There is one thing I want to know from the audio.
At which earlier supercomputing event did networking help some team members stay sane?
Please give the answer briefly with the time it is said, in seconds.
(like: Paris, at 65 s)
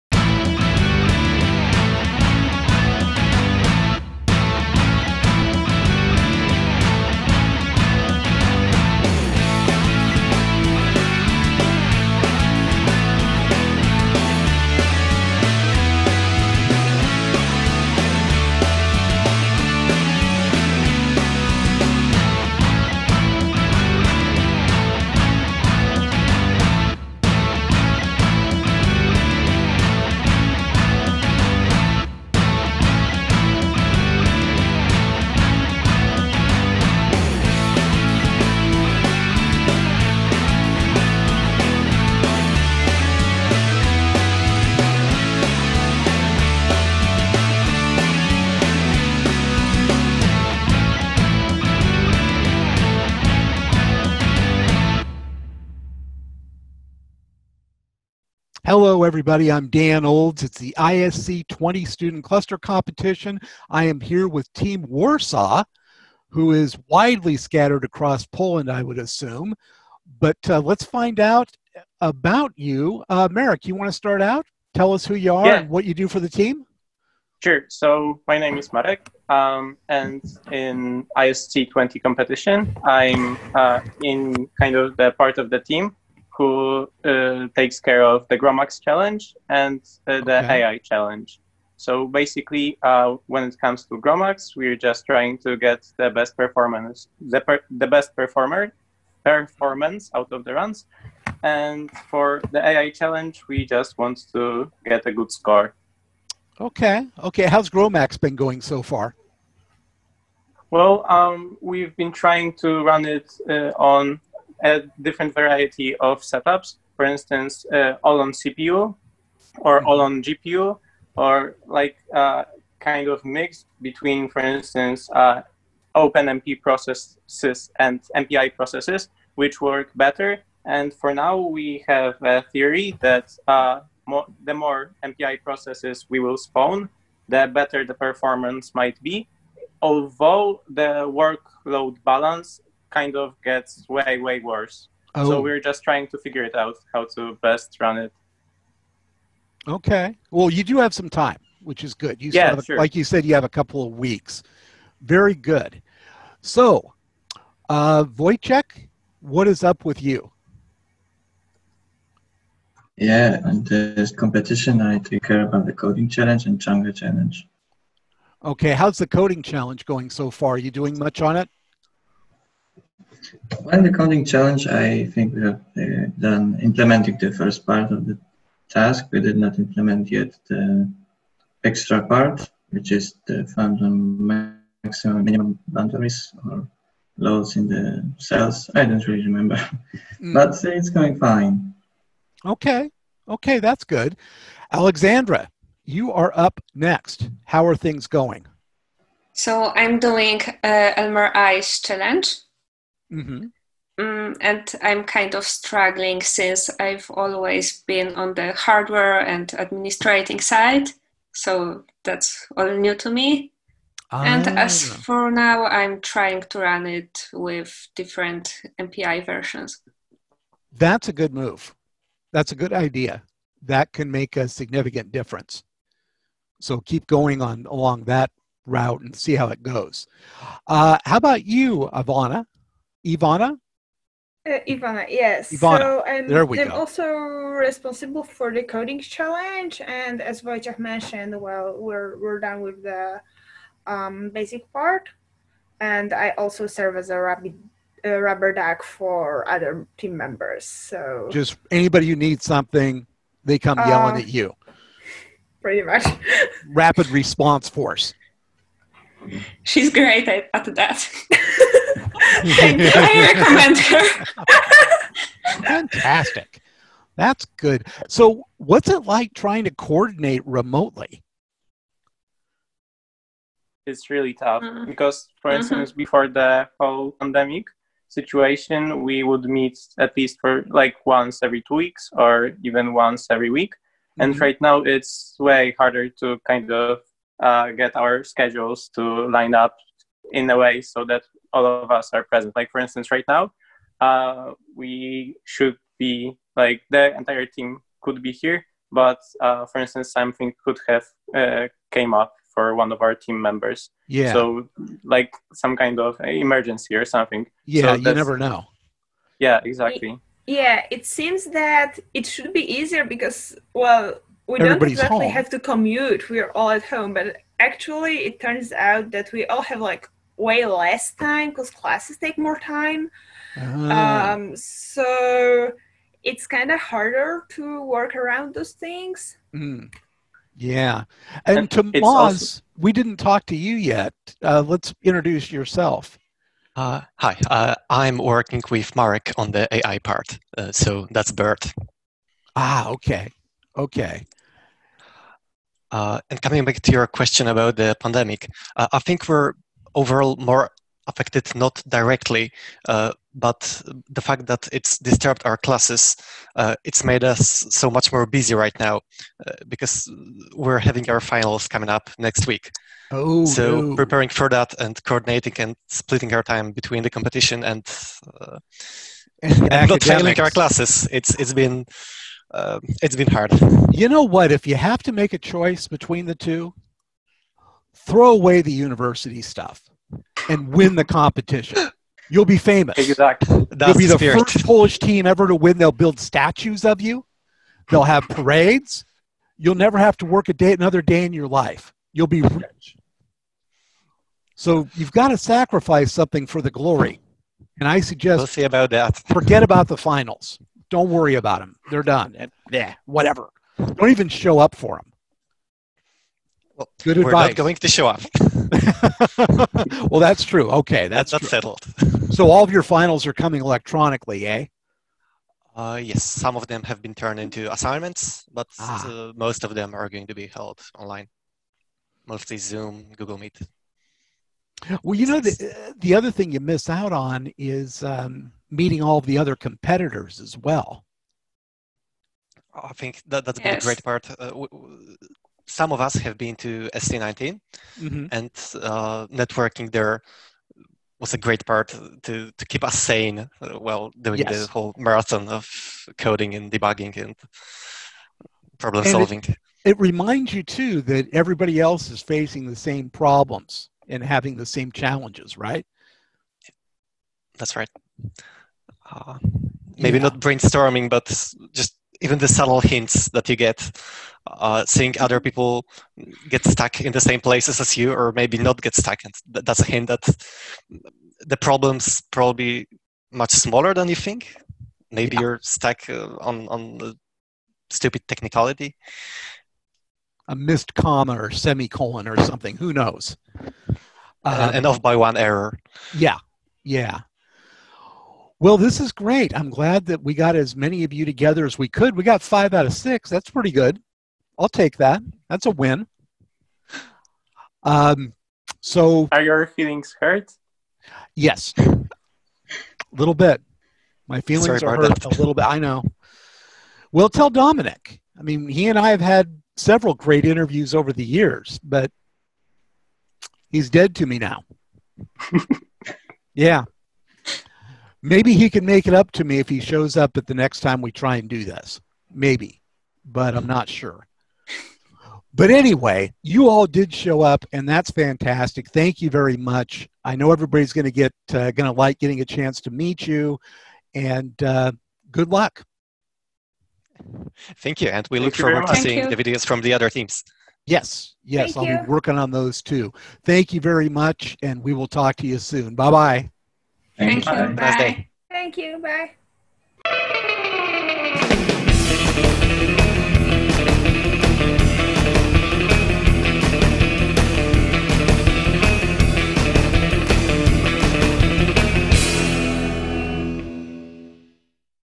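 SC19, at 436 s.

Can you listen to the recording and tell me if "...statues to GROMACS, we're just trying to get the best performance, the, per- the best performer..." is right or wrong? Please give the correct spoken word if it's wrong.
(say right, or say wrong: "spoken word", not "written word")
wrong: "comes", not "statues".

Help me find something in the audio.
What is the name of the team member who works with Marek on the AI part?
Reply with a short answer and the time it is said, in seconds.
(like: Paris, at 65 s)
Bert, at 341 s.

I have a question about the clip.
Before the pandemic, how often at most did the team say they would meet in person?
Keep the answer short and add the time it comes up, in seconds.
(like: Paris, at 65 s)
Once every week, at 282 s.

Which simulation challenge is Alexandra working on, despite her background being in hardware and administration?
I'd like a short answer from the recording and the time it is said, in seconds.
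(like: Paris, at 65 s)
Elmer Ice, at 200 s.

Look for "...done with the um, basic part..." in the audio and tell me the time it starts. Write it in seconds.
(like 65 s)
242 s.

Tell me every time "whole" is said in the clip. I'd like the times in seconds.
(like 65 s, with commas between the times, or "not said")
276 s, 444 s.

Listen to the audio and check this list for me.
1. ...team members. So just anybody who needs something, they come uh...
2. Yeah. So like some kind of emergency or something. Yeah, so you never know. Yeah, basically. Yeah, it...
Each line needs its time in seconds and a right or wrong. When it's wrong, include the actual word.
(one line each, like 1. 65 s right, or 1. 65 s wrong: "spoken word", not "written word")
1. 249 s right
2. 304 s wrong: "exactly", not "basically".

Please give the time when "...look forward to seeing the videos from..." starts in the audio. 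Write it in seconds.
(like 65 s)
538 s.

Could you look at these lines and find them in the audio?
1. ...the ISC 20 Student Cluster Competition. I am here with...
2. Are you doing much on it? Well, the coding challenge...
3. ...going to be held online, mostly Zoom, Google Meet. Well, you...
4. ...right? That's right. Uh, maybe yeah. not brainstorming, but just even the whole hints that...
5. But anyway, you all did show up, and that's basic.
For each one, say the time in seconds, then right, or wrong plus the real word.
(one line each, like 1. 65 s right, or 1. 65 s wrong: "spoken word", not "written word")
1. 60 s right
2. 170 s right
3. 420 s right
4. 455 s wrong: "subtle", not "whole"
5. 525 s wrong: "fantastic", not "basic".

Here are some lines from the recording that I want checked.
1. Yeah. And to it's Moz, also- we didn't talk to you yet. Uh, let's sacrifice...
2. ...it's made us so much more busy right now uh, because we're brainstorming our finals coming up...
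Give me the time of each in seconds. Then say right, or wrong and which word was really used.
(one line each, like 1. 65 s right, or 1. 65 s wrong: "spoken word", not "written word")
1. 330 s wrong: "introduce", not "sacrifice"
2. 356 s wrong: "having", not "brainstorming".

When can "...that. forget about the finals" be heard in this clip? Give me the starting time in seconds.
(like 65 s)
398 s.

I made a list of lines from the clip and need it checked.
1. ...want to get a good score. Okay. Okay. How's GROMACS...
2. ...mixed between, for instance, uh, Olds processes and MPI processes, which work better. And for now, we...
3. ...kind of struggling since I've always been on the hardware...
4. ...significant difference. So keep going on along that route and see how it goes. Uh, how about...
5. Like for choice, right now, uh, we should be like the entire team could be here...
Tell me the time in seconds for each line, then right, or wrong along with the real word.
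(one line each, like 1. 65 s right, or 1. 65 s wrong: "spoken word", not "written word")
1. 103 s right
2. 123 s wrong: "OpenMP", not "Olds"
3. 205 s right
4. 224 s right
5. 292 s wrong: "instance", not "choice".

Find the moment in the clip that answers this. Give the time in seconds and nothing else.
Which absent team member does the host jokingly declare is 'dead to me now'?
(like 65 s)
507 s.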